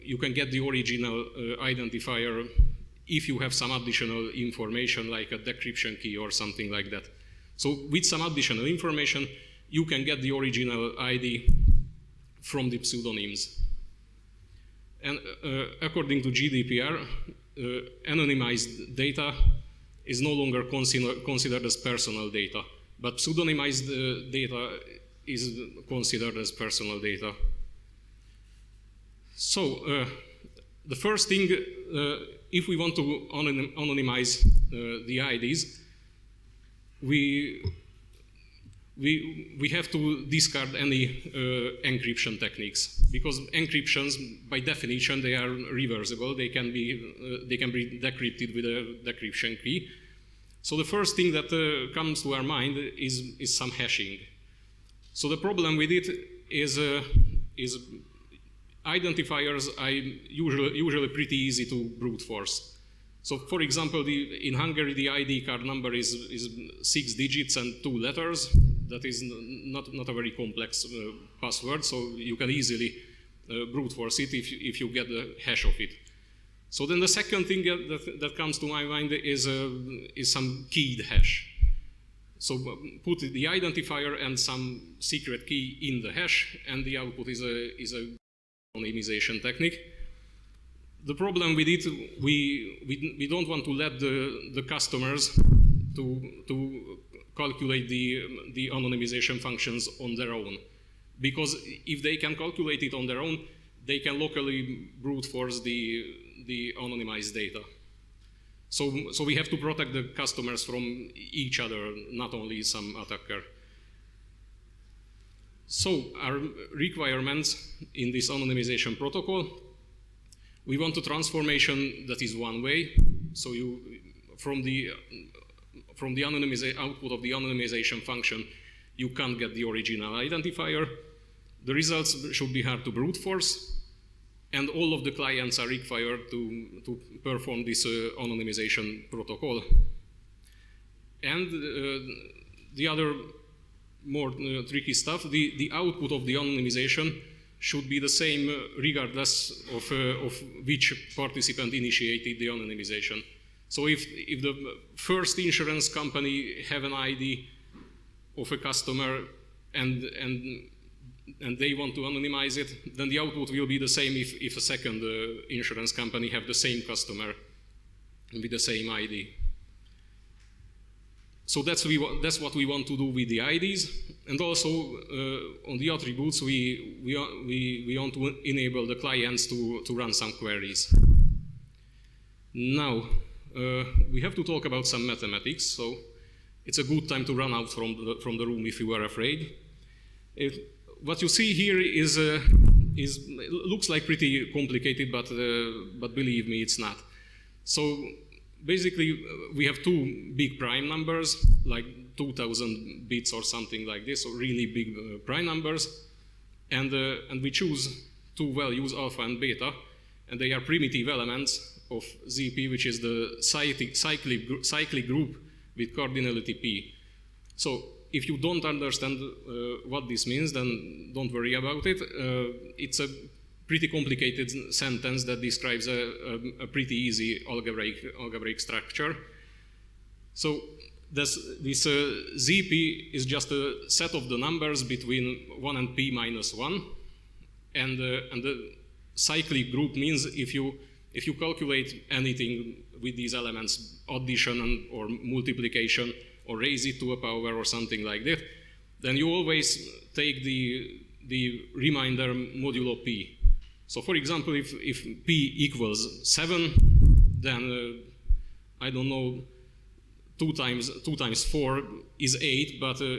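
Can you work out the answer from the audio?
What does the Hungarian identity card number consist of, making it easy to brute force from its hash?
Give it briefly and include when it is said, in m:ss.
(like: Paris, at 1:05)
6 digits and 2 letters, at 1:06.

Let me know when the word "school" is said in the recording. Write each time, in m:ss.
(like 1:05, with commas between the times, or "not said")
not said.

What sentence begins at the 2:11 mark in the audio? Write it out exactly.
The results should be hard to brute force, and all of the clients are required to, to perform this uh, anonymization protocol.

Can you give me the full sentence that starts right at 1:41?
Because if they can calculate it on their own, they can locally brute force the, the anonymized data.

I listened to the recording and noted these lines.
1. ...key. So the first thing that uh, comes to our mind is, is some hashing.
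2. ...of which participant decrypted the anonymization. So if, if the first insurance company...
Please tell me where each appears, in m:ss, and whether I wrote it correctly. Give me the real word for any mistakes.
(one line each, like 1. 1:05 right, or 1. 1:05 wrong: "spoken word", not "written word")
1. 0:49 right
2. 2:30 wrong: "initiated", not "decrypted".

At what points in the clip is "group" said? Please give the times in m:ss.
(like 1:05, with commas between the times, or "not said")
3:35, 3:59.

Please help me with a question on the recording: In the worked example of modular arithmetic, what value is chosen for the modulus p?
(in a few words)
7.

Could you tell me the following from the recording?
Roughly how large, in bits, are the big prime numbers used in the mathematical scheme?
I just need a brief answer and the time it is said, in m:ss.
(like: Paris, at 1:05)
2,000 bits, at 3:22.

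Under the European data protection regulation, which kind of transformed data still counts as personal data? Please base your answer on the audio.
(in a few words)
Pseudonymized data.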